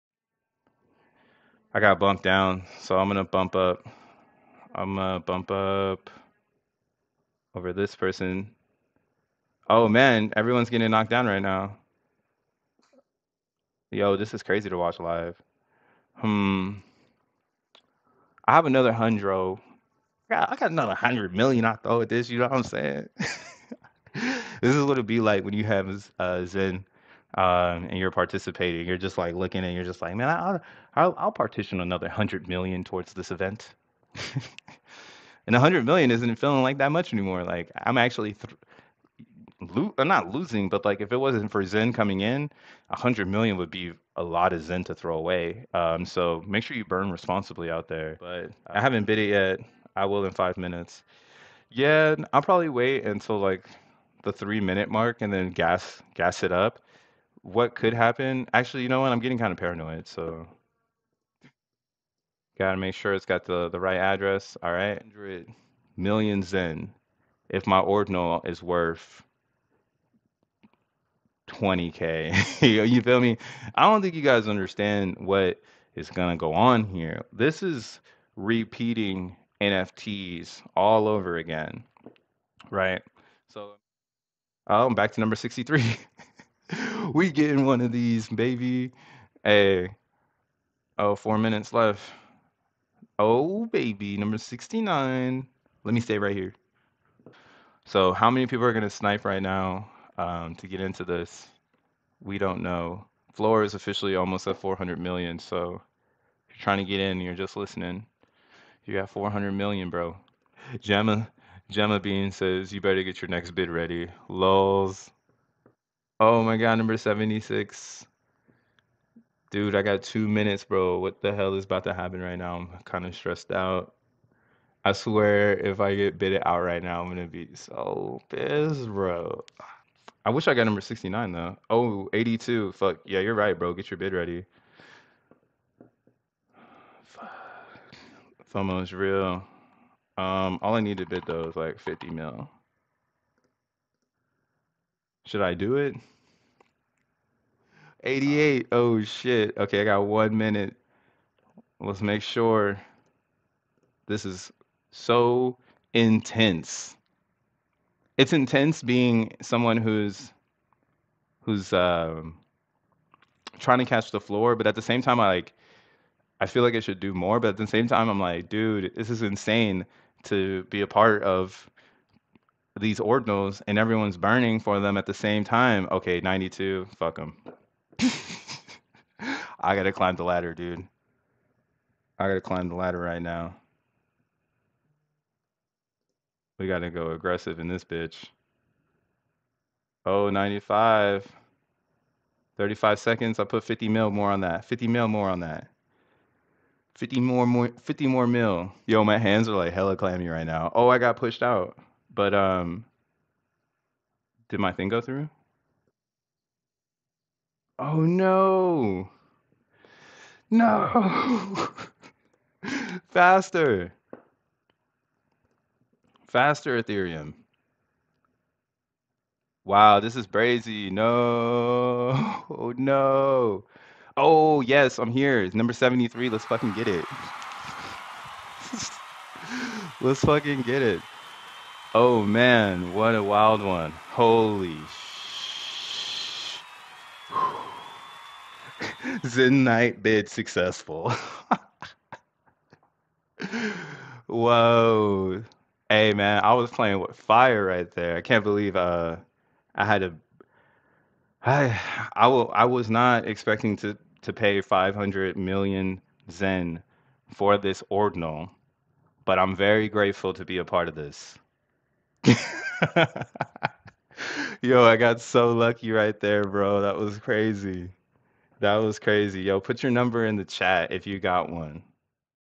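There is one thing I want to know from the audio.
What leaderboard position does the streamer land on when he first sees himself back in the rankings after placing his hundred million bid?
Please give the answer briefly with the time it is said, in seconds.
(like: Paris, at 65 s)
63, at 85 s.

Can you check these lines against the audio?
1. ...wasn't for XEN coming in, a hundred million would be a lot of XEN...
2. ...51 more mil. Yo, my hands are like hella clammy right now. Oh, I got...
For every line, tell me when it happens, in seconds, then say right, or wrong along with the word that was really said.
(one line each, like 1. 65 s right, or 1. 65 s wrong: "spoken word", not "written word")
1. 41 s right
2. 197 s wrong: "50", not "51".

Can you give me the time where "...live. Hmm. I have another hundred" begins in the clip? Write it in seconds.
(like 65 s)
14 s.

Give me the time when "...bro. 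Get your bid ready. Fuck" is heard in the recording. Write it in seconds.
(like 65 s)
133 s.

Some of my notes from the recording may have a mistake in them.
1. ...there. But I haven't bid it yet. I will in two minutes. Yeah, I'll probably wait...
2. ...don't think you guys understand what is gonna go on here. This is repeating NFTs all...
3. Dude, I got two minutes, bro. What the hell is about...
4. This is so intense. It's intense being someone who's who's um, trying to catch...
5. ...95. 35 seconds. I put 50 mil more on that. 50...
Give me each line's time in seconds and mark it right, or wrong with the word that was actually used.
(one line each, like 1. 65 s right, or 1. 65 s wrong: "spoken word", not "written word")
1. 47 s wrong: "five", not "two"
2. 73 s right
3. 119 s right
4. 154 s right
5. 190 s right.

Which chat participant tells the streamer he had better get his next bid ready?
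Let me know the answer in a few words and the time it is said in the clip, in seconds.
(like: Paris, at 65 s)
Gemma Bean, at 111 s.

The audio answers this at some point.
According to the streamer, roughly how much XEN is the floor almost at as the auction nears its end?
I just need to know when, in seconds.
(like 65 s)
104 s.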